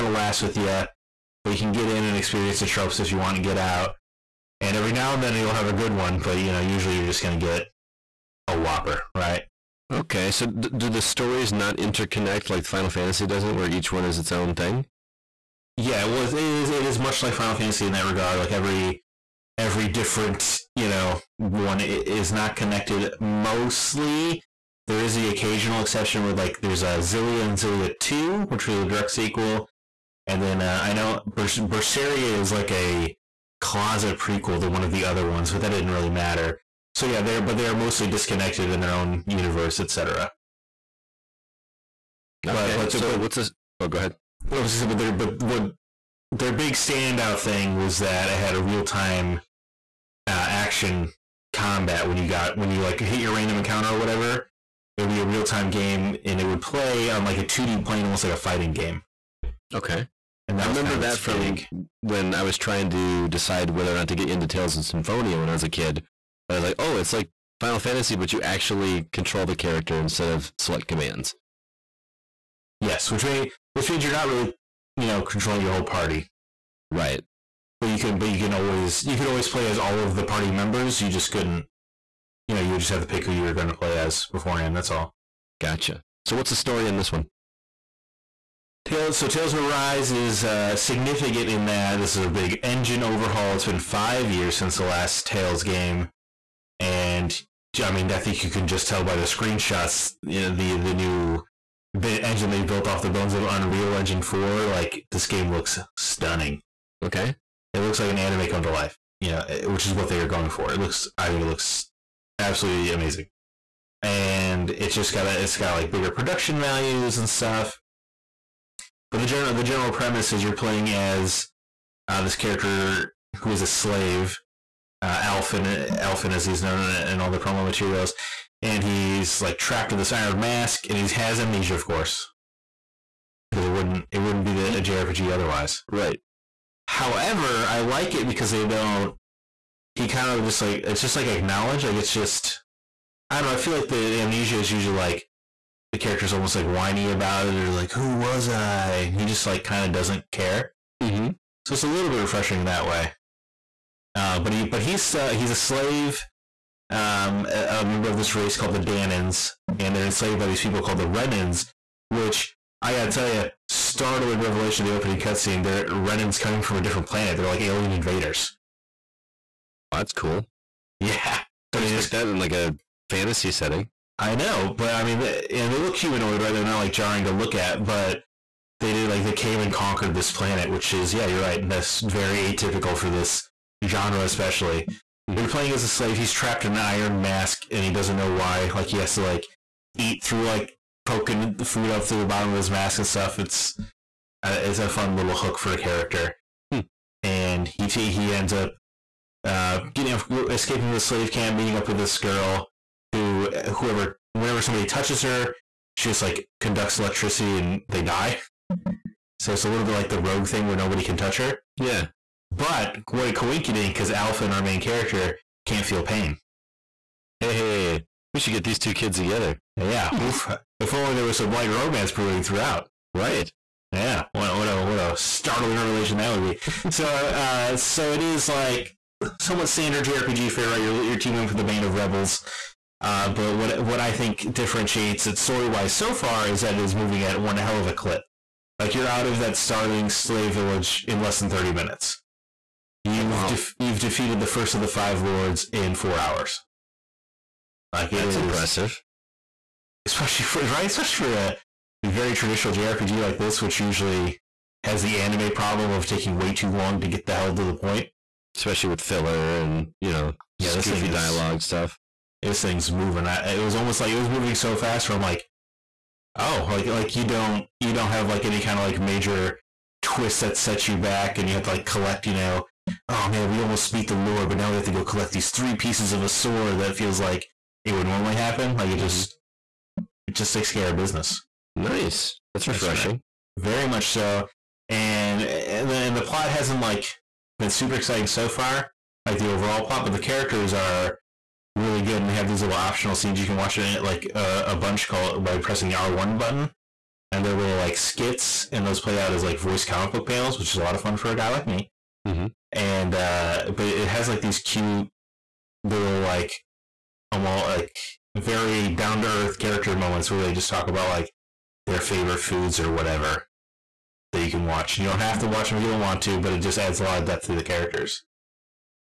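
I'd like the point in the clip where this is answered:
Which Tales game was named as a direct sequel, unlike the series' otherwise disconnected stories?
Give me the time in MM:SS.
00:27.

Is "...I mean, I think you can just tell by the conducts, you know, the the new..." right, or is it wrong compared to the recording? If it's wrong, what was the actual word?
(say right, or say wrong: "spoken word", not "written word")
wrong: "screenshots", not "conducts".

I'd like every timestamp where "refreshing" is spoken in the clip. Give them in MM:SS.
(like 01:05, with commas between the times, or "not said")
02:32, 04:42.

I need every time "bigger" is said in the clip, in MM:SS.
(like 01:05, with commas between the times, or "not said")
01:55.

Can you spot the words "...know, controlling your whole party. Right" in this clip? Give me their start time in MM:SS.
01:15.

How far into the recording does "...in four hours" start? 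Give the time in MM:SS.
04:05.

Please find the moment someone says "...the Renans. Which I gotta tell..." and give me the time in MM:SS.
02:40.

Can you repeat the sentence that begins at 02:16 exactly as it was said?
However, I like it because they don't.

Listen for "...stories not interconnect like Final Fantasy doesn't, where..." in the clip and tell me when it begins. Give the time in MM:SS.
00:11.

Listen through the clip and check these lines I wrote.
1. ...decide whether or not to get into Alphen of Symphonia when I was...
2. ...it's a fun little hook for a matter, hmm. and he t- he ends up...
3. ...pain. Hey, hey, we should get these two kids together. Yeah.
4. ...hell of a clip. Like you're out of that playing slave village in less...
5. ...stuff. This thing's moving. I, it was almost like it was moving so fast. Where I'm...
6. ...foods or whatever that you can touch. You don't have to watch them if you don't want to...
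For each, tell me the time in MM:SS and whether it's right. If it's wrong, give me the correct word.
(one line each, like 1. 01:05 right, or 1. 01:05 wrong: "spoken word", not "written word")
1. 01:03 wrong: "Tales", not "Alphen"
2. 03:14 wrong: "character", not "matter"
3. 03:36 right
4. 03:57 wrong: "startling", not "playing"
5. 04:21 right
6. 05:12 wrong: "watch", not "touch".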